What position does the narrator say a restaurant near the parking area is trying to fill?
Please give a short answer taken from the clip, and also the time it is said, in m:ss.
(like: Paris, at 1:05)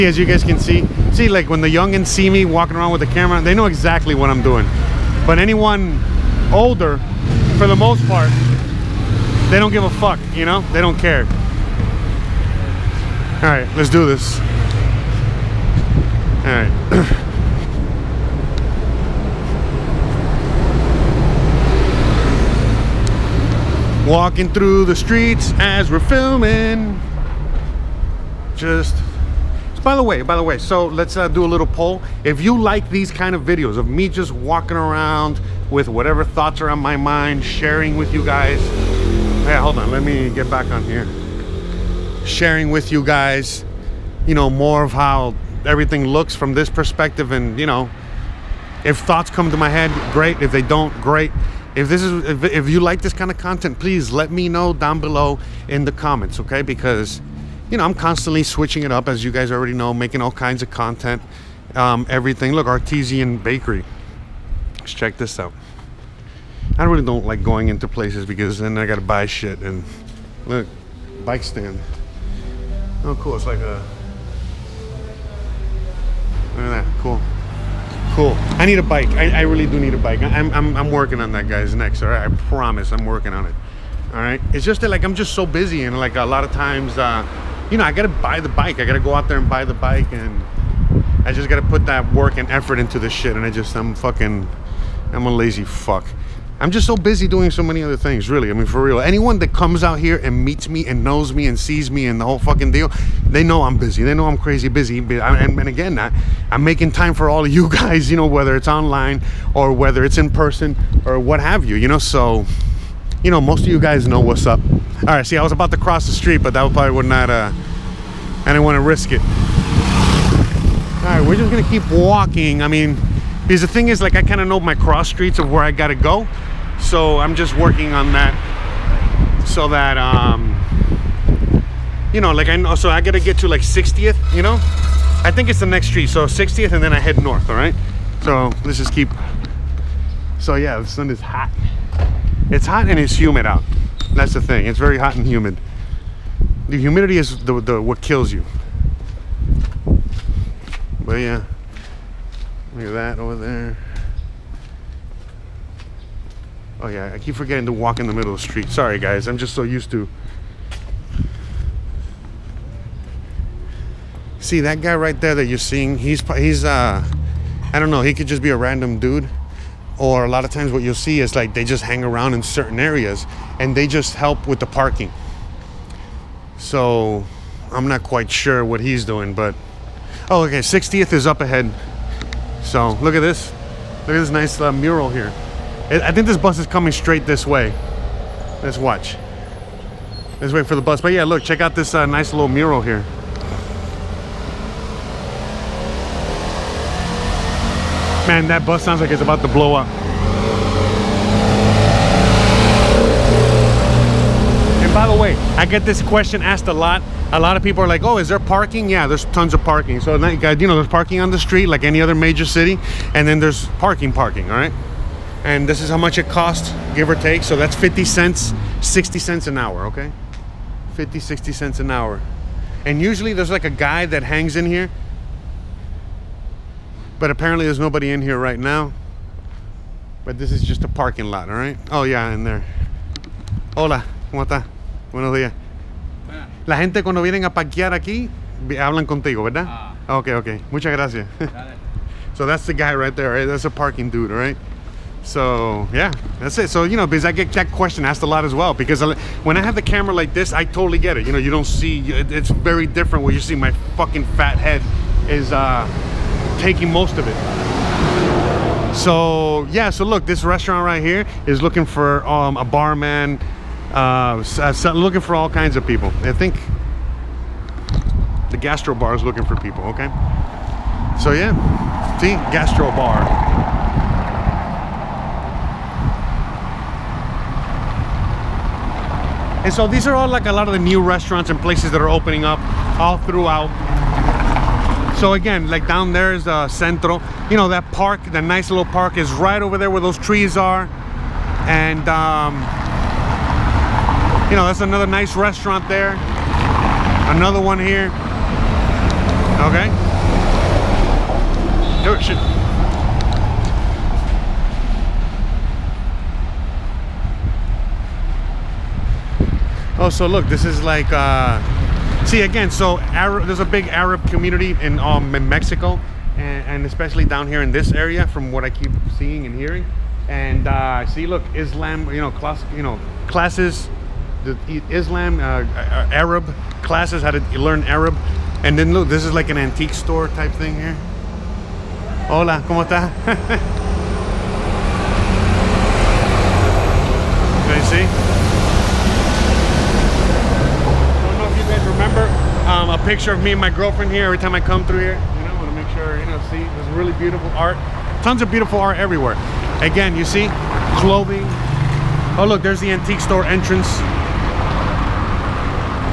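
Barman, at 4:22.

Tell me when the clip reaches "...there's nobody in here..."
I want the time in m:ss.
3:47.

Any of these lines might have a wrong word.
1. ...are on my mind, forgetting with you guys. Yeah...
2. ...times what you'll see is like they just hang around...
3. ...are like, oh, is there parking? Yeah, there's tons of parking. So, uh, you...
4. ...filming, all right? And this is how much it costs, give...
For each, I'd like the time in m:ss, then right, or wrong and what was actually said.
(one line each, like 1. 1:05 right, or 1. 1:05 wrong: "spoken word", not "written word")
1. 0:36 wrong: "sharing", not "forgetting"
2. 2:50 right
3. 3:27 right
4. 3:34 wrong: "parking", not "filming".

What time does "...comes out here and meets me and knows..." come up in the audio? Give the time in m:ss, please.
1:39.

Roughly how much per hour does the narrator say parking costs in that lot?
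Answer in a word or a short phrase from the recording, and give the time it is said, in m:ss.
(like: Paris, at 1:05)
50 to 60 cents, at 3:40.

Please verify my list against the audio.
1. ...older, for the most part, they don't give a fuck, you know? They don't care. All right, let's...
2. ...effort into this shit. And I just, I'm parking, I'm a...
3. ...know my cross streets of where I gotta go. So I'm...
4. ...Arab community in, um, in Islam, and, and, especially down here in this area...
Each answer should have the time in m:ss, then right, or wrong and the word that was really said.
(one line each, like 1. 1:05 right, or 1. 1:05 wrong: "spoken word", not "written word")
1. 0:06 right
2. 1:32 wrong: "fucking", not "parking"
3. 2:04 right
4. 5:13 wrong: "Mexico", not "Islam".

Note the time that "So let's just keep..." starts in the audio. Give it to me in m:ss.
2:18.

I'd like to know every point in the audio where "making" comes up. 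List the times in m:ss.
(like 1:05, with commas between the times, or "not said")
0:59, 1:46.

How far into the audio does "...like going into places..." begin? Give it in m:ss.
1:07.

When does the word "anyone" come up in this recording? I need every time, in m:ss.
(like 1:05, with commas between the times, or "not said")
0:05, 1:38.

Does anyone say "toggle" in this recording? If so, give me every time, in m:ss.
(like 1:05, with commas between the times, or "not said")
not said.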